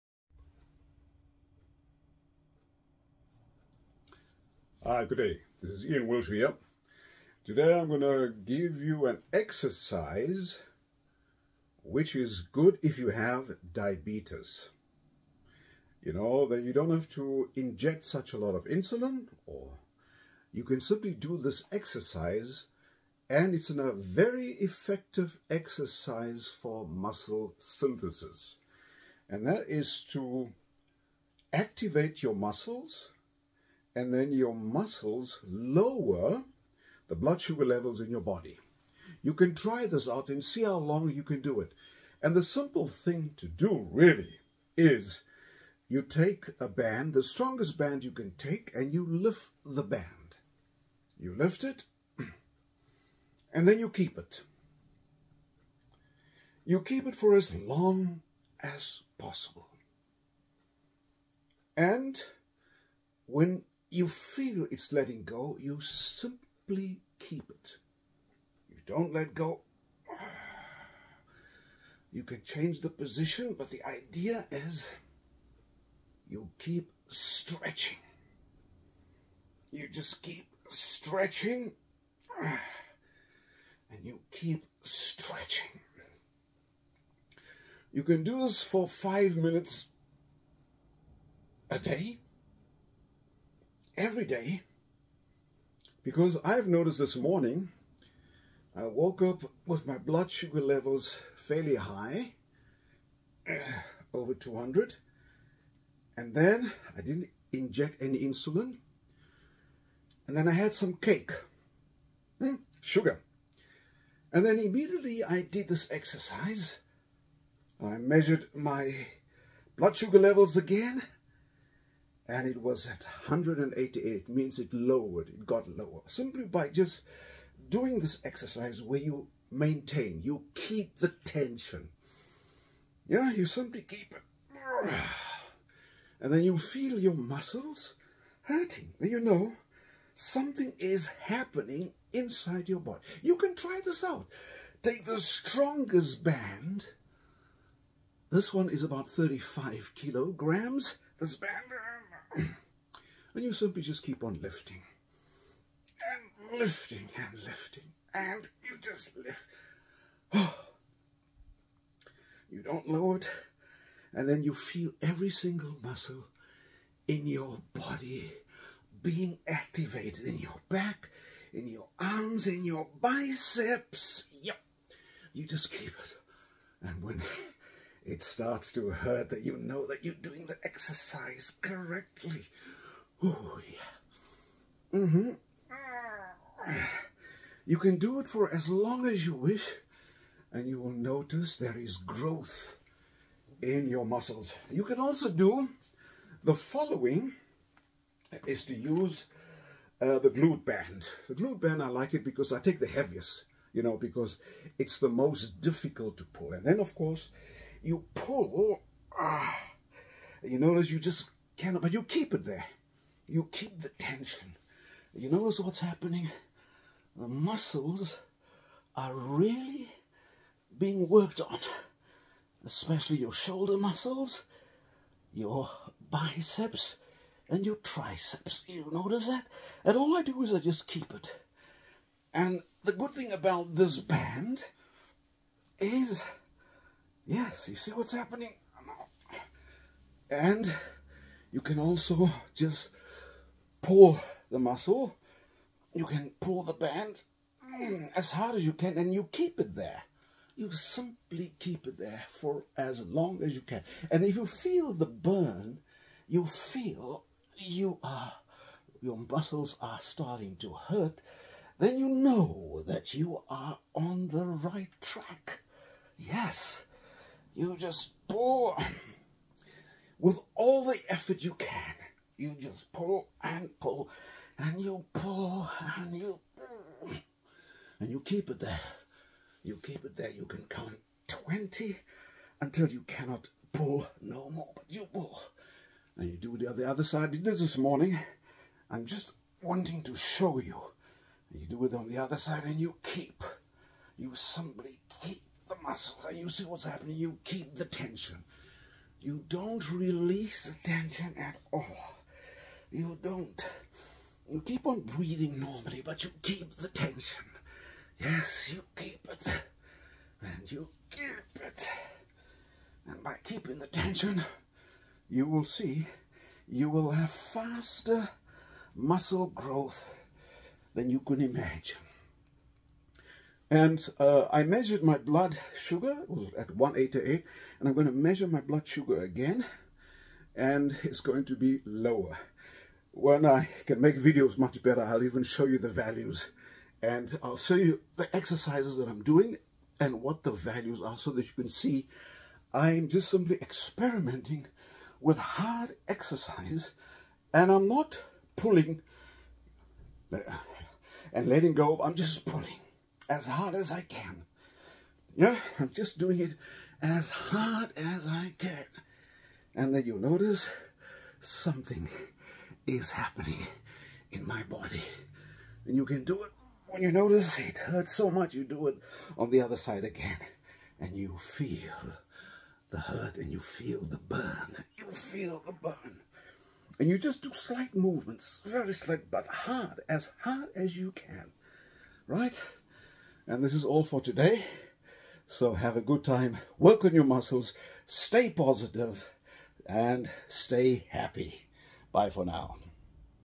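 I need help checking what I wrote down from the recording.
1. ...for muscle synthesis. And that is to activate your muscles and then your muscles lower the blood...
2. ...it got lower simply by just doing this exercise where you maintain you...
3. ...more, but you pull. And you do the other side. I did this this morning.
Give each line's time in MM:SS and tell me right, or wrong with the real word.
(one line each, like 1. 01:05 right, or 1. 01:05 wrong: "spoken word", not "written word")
1. 00:26 right
2. 02:05 right
3. 04:44 right.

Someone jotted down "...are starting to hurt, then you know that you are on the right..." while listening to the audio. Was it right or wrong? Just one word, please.
right.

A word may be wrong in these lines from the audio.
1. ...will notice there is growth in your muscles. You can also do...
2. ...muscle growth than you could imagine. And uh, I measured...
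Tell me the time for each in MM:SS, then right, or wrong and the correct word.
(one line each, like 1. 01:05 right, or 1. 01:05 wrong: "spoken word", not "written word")
1. 03:10 right
2. 05:18 right.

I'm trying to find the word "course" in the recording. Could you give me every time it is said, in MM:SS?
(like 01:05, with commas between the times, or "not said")
03:26.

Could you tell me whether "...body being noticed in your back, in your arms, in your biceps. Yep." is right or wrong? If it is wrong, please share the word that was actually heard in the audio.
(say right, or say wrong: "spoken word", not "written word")
wrong: "activated", not "noticed".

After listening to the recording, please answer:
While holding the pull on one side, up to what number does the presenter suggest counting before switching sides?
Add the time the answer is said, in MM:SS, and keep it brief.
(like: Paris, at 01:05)
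20, at 04:41.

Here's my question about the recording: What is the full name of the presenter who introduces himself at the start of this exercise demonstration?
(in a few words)
Ian Wiltshire.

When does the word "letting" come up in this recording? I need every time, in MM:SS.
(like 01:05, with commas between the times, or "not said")
01:04, 05:51.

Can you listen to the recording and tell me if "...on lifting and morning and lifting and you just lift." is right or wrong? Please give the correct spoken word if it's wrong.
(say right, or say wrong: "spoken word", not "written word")
wrong: "lifting", not "morning".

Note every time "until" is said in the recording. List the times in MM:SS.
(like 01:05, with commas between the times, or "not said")
04:42.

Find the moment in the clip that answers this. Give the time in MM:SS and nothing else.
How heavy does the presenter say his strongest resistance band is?
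02:29.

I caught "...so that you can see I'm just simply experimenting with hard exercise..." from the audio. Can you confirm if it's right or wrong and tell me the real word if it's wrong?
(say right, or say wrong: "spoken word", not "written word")
right.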